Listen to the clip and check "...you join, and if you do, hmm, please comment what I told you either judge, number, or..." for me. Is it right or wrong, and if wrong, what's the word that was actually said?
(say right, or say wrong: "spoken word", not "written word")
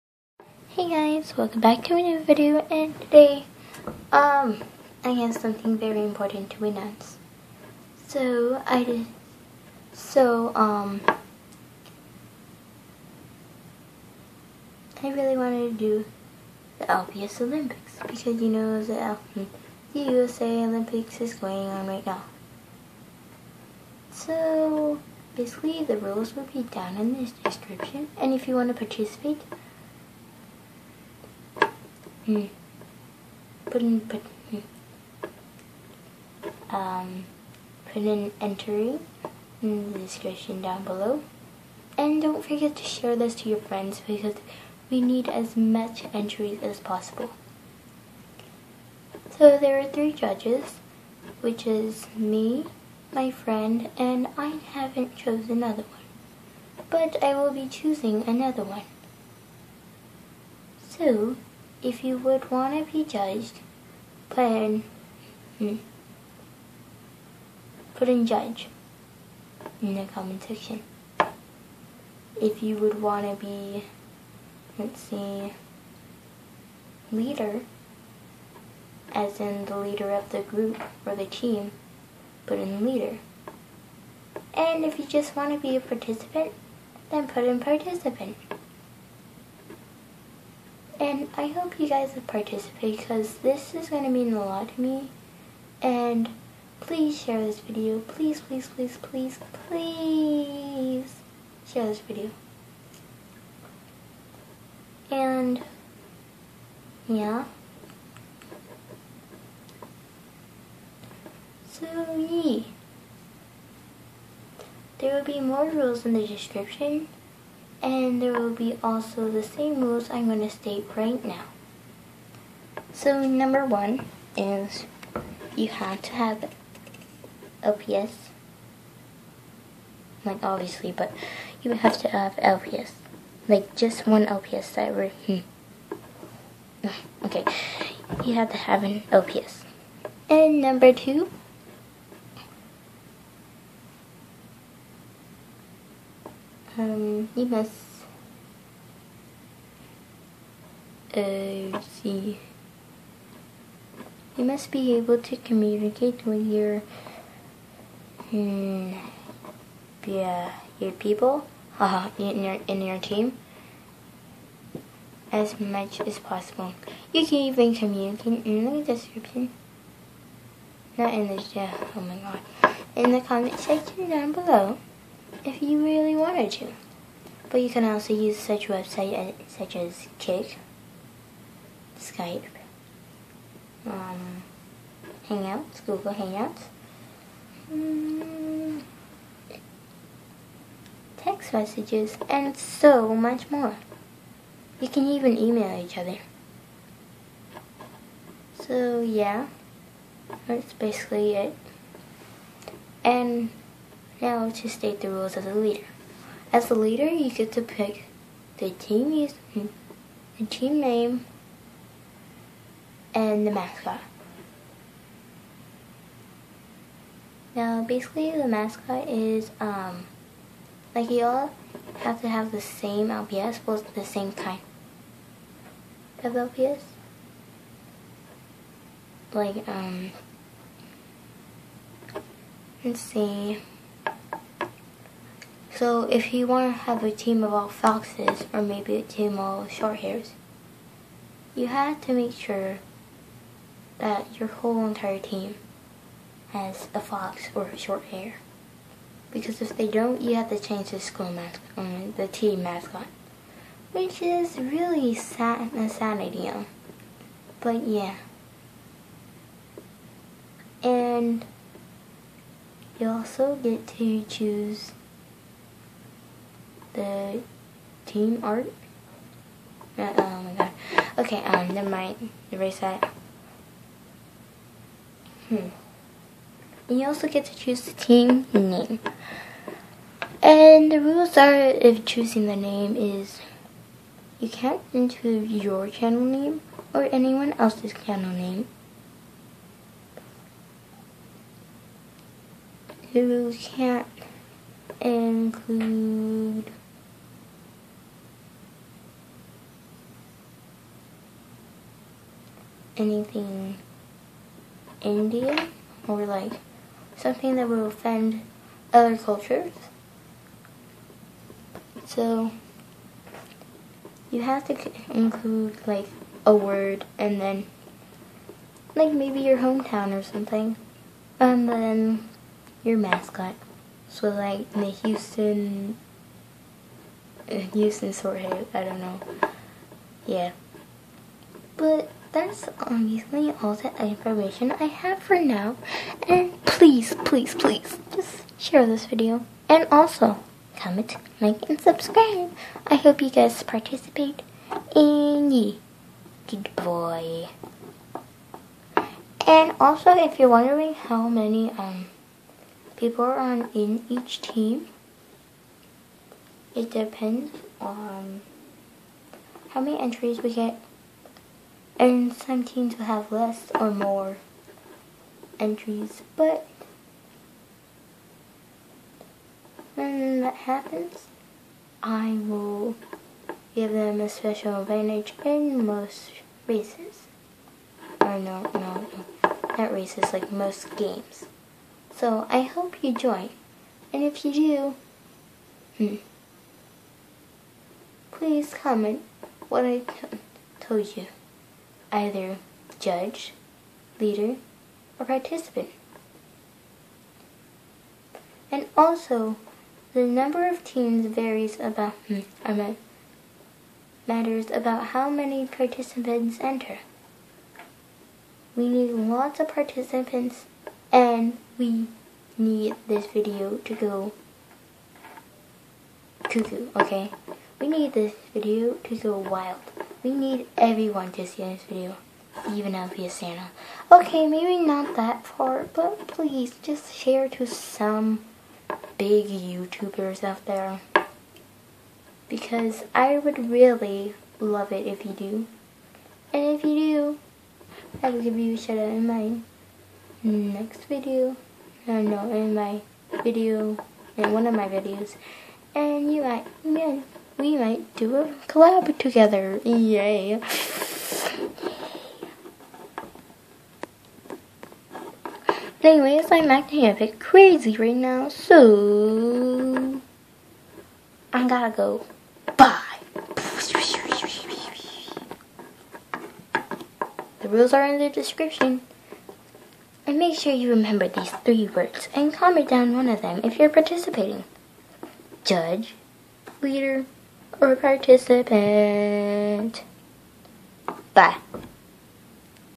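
wrong: "leader", not "number".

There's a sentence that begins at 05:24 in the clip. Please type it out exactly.
So like the Houston uh, Houston Swordhead, I don't know.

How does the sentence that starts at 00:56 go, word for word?
But I will be choosing another one.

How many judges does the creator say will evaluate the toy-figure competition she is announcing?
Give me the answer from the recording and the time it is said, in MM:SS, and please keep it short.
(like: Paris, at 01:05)
3, at 00:49.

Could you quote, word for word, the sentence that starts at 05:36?
And please, please, please, just share this video.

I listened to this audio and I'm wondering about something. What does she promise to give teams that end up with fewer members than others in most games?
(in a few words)
special advantage.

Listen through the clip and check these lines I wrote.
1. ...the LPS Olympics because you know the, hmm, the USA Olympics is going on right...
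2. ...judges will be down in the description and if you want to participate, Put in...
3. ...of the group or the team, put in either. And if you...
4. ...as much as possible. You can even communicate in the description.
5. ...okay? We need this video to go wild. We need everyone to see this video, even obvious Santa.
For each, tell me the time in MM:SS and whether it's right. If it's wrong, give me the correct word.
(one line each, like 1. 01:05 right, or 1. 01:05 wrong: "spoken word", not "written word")
1. 00:16 right
2. 00:25 wrong: "rules", not "judges"
3. 01:20 wrong: "leader", not "either"
4. 02:45 right
5. 06:56 right.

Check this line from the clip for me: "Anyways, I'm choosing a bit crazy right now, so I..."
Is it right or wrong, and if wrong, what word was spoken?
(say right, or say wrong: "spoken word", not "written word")
wrong: "acting", not "choosing".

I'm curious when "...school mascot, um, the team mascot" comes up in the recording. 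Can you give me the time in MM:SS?
04:10.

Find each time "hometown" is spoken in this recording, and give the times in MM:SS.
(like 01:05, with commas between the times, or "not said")
05:19.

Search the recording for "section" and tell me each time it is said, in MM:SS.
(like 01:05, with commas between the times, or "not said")
01:10, 02:53.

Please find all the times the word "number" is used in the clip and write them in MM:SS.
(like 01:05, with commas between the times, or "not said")
02:03, 02:20, 06:40.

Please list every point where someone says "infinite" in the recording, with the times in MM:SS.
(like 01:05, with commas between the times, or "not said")
not said.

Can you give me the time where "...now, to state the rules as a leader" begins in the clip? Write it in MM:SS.
03:24.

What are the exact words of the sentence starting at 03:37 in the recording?
Now, basically, the mascot is um, like you all have to have the same LPS, but the same kind of LPS.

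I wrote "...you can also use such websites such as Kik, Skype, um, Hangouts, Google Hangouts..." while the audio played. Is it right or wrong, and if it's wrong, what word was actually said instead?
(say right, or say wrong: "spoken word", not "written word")
right.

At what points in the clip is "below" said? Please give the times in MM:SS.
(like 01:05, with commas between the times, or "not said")
00:40, 02:54.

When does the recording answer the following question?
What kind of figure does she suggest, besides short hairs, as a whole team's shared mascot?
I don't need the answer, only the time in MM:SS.
03:57.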